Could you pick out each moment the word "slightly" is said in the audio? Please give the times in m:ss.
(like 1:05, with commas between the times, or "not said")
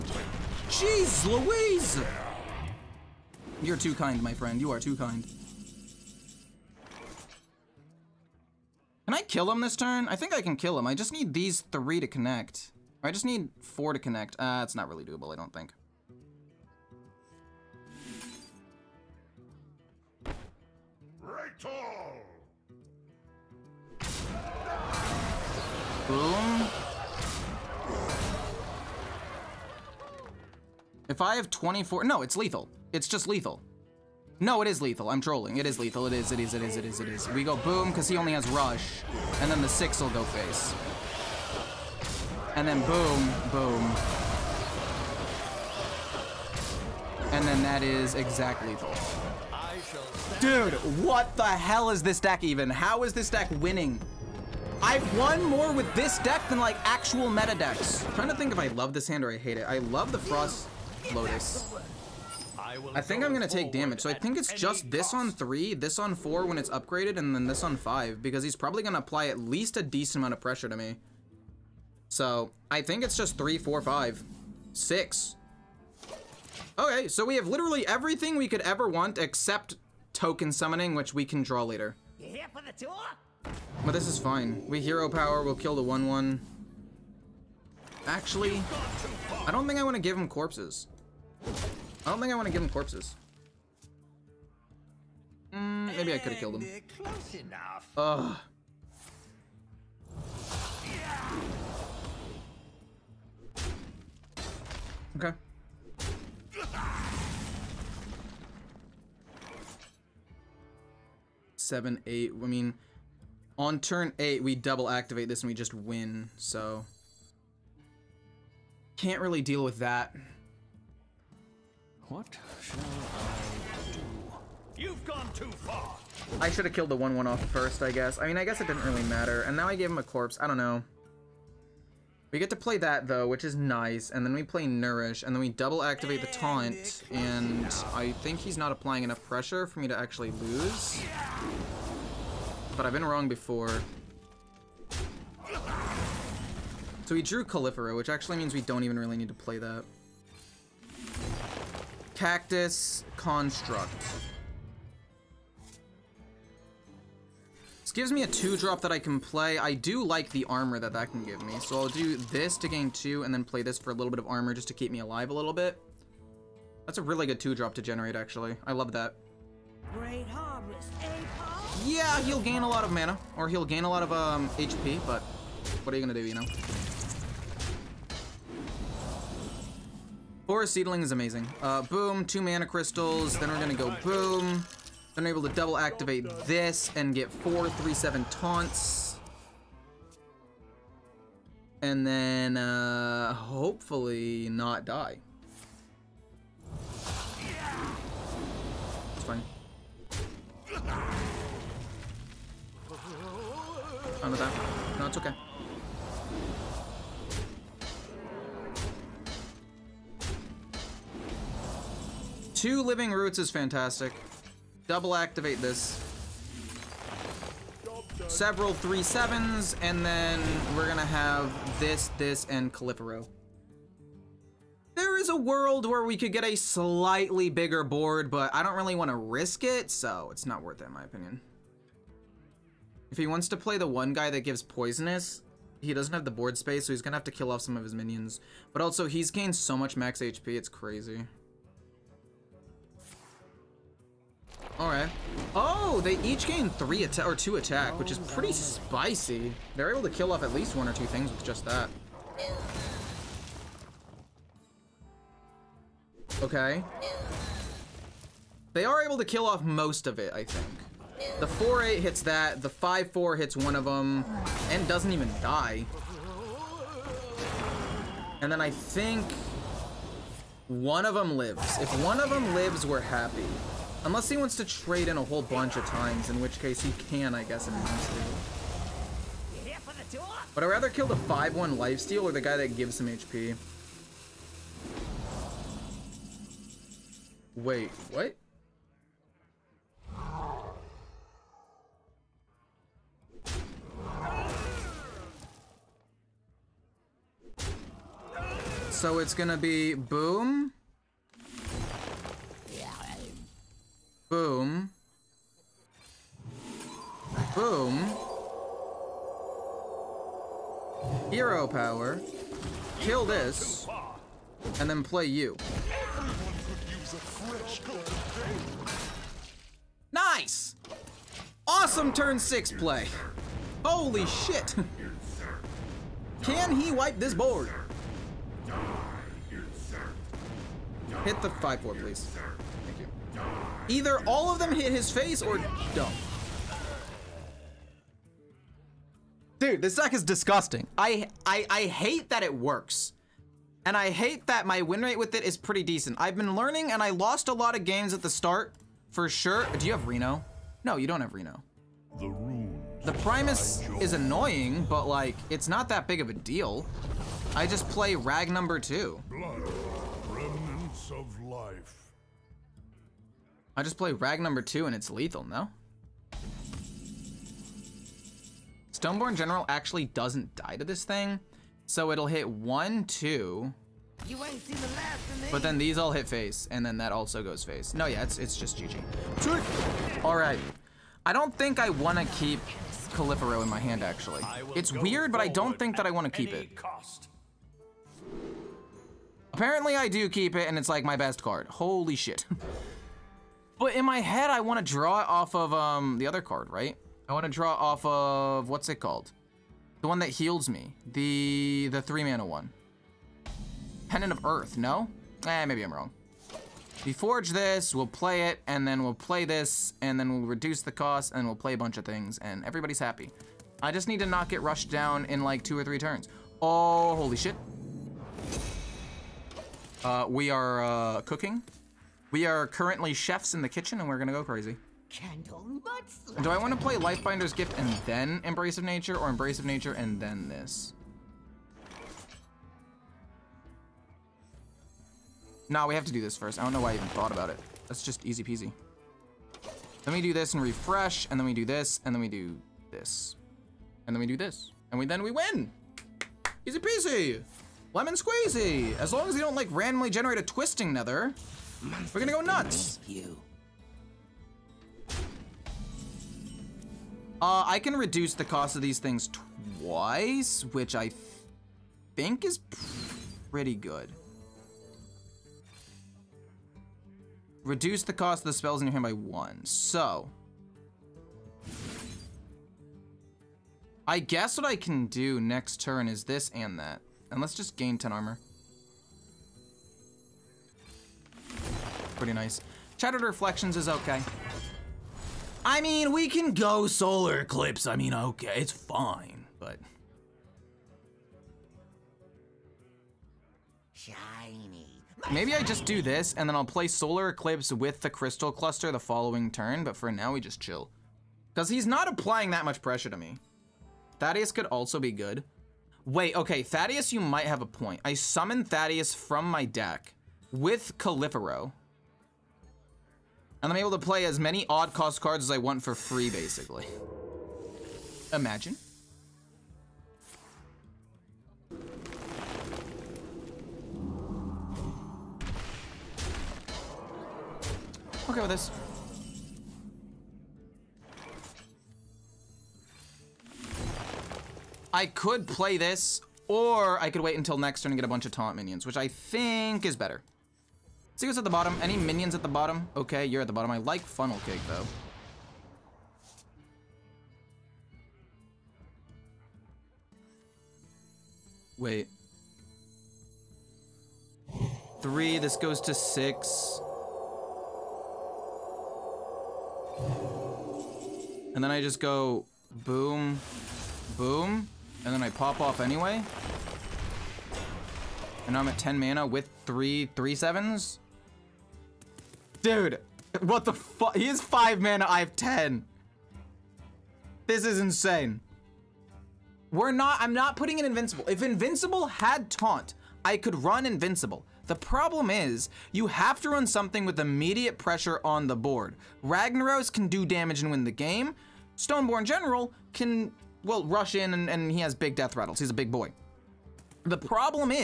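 3:46.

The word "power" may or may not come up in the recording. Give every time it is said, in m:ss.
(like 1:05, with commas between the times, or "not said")
1:25, 5:11.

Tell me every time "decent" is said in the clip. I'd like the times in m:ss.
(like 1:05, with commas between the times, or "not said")
1:09, 5:45.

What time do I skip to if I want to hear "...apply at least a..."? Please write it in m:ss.
1:08.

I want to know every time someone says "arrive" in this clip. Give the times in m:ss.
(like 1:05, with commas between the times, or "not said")
not said.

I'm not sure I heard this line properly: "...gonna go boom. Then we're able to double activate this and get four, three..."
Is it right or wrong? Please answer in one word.
right.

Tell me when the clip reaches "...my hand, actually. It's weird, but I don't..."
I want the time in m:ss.
6:23.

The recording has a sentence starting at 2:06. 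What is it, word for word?
I should have killed the 1-1 off first, I guess.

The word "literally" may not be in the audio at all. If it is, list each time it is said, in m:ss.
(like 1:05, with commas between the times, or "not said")
1:17.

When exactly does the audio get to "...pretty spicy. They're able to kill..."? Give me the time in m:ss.
4:08.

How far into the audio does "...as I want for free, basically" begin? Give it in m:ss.
8:35.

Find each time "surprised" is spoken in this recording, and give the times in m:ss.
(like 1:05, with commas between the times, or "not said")
not said.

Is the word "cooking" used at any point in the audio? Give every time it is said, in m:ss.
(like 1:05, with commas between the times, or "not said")
7:01.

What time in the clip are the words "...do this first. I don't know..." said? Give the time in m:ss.
7:16.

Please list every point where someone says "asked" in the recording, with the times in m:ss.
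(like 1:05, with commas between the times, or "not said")
not said.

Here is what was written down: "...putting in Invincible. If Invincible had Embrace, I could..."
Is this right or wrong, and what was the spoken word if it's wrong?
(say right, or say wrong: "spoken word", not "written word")
wrong: "Taunt", not "Embrace".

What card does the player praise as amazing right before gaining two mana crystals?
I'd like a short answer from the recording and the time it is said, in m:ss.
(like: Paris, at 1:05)
Forest Seedling, at 3:00.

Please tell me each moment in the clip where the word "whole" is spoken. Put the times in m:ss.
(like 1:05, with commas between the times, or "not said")
4:35.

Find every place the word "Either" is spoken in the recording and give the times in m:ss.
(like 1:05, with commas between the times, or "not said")
5:33.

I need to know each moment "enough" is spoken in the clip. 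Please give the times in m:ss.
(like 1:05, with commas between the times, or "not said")
1:37, 2:19.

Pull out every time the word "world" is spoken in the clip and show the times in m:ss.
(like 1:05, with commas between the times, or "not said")
3:45.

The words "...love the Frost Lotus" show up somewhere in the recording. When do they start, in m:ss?
0:59.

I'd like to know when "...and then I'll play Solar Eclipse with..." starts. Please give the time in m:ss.
8:16.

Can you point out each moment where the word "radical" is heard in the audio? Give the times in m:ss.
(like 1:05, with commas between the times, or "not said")
not said.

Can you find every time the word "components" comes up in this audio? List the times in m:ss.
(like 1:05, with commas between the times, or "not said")
not said.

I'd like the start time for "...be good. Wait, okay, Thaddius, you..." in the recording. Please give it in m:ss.
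8:25.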